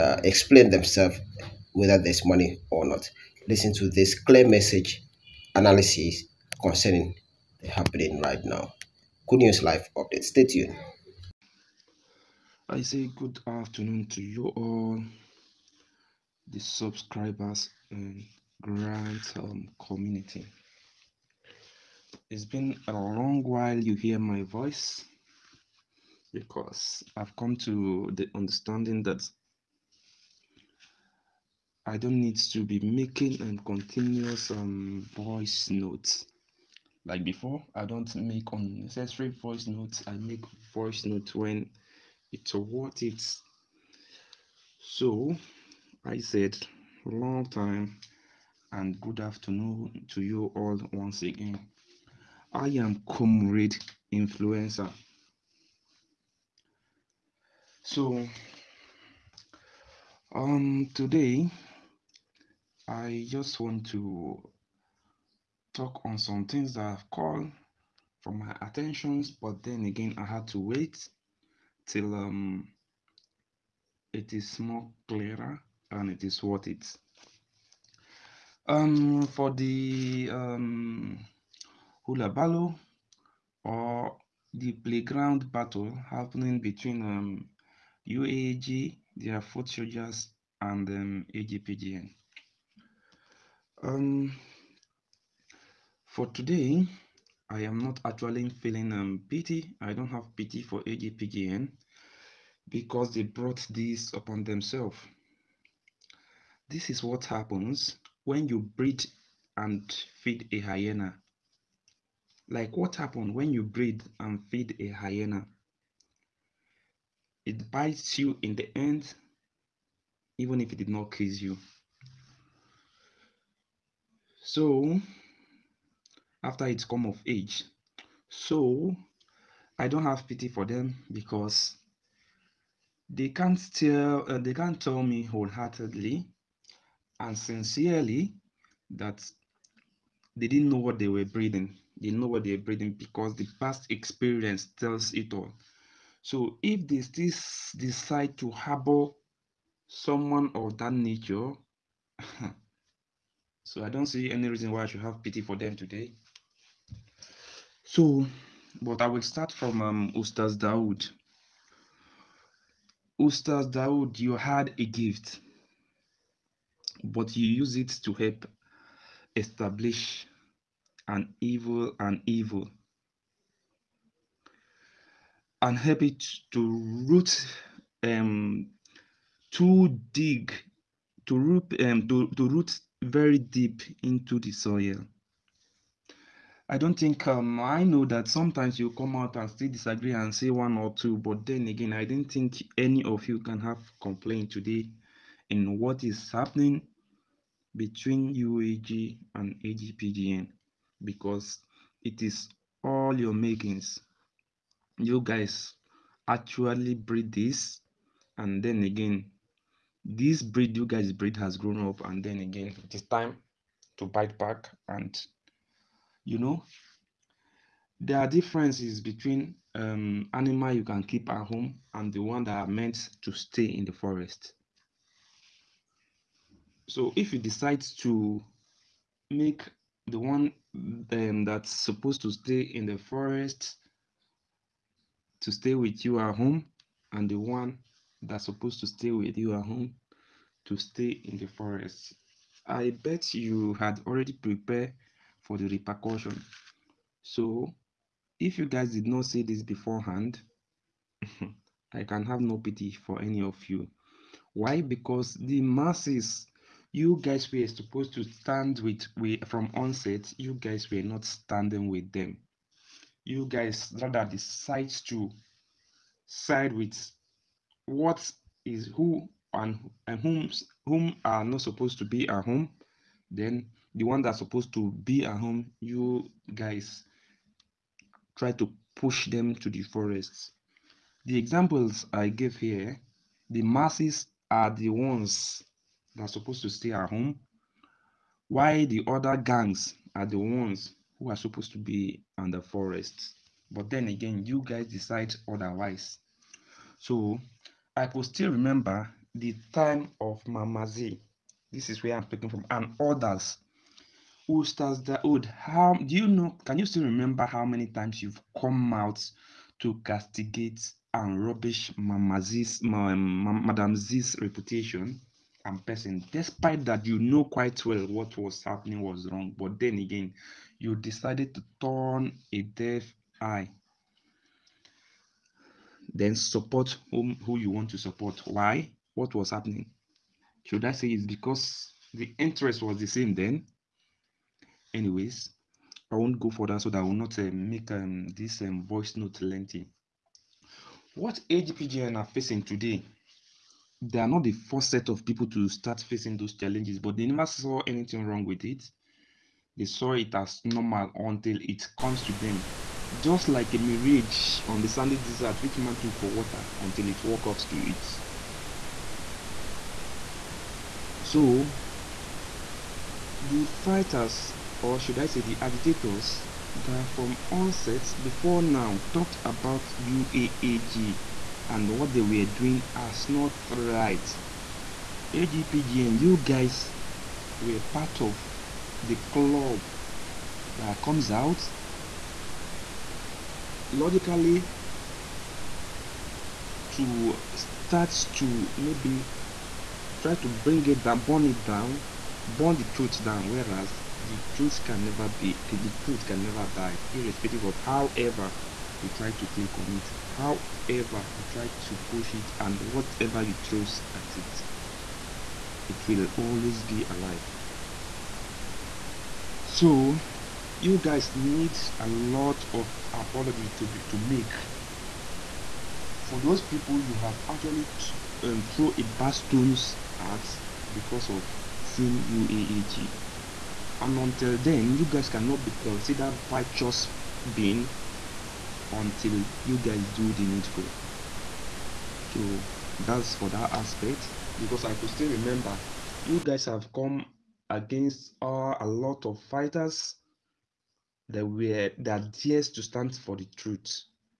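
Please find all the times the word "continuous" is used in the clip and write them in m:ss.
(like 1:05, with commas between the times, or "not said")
0:33.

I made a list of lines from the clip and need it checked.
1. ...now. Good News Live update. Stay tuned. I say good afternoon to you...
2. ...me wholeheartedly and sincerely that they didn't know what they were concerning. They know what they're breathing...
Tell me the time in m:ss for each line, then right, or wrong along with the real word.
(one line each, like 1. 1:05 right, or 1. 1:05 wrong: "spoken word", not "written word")
1. 0:08 right
2. 2:15 wrong: "breathing", not "concerning".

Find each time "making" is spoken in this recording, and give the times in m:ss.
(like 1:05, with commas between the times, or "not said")
0:32, 3:23.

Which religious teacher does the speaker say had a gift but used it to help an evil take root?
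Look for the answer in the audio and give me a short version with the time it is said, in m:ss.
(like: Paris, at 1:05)
Ustaz Dawood, at 2:40.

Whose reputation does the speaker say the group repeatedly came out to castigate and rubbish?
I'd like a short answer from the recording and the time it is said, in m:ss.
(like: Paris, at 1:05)
Madam Z, at 5:13.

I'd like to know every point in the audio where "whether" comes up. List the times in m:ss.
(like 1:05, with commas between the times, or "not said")
0:01.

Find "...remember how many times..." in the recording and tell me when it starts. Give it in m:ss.
5:07.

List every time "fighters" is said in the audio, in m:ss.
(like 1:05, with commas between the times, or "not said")
6:03, 7:19.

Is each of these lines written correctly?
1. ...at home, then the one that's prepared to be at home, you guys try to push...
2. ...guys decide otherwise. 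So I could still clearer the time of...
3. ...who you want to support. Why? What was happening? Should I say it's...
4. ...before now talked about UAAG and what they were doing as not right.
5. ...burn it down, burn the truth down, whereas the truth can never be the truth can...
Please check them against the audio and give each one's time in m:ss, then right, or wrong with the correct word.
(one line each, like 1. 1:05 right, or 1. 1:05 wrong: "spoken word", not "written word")
1. 4:32 wrong: "supposed", not "prepared"
2. 4:54 wrong: "remember", not "clearer"
3. 5:27 right
4. 6:08 right
5. 6:31 right.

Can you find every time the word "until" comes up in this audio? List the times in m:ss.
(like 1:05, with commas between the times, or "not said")
5:51, 5:56, 7:04, 7:08.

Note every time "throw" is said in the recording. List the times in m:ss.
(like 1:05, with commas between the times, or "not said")
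6:43, 6:58.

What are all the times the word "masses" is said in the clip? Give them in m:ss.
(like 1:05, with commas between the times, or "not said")
4:15, 4:43.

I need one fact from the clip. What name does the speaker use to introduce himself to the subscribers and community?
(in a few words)
Comrade Influencer.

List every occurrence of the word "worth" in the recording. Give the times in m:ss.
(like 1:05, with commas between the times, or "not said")
0:42, 1:16.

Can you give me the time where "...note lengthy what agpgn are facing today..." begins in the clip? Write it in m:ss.
5:39.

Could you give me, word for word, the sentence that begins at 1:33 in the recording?
Um, for today, I am not actually feeling um, pity.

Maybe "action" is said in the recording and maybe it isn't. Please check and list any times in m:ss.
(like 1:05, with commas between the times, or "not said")
not said.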